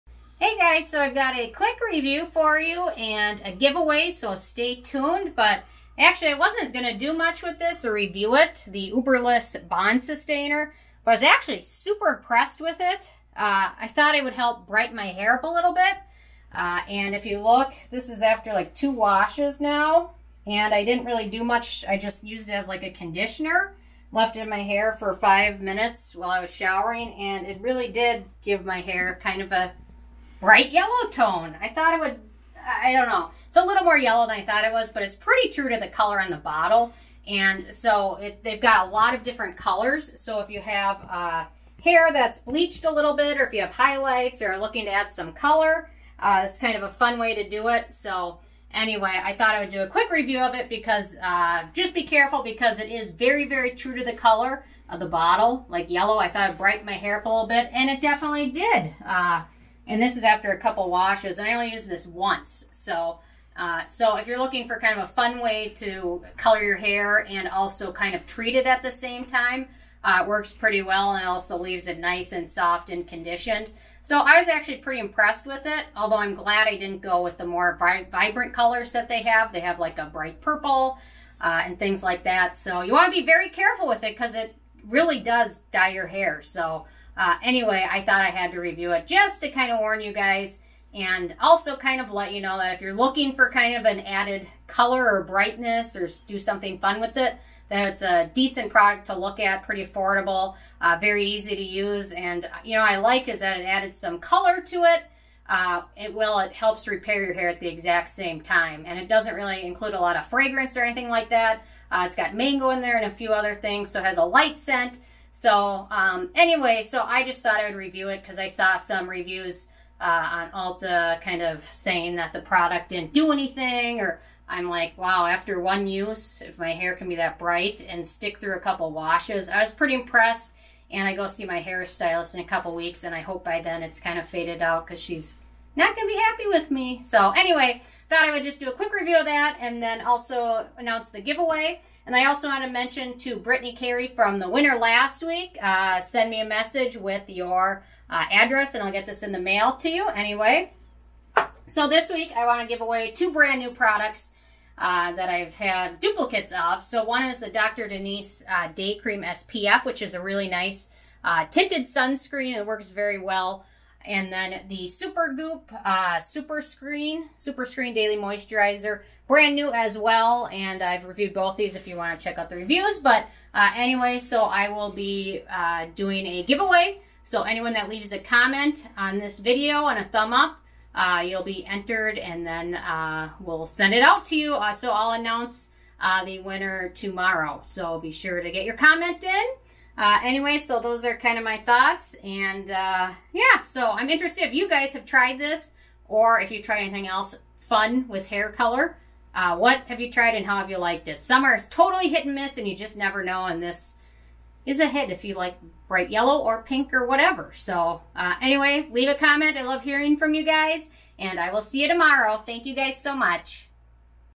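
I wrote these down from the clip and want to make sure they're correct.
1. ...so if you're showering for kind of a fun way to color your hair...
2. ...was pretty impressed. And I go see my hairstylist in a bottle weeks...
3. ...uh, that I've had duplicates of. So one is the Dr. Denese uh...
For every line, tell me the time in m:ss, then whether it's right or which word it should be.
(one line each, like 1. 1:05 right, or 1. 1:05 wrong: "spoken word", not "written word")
1. 1:03 wrong: "looking", not "showering"
2. 2:09 wrong: "couple", not "bottle"
3. 2:34 right.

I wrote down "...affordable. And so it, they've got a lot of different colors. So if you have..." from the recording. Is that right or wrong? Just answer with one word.
wrong.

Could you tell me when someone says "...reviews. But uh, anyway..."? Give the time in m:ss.
2:52.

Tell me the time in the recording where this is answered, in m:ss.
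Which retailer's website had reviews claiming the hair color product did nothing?
2:00.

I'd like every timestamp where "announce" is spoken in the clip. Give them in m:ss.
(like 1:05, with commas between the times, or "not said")
2:20, 3:05.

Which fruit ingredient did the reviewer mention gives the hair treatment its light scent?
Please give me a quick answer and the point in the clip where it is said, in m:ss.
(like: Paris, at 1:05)
Mango, at 1:52.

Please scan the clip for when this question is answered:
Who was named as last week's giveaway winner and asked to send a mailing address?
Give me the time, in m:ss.
2:23.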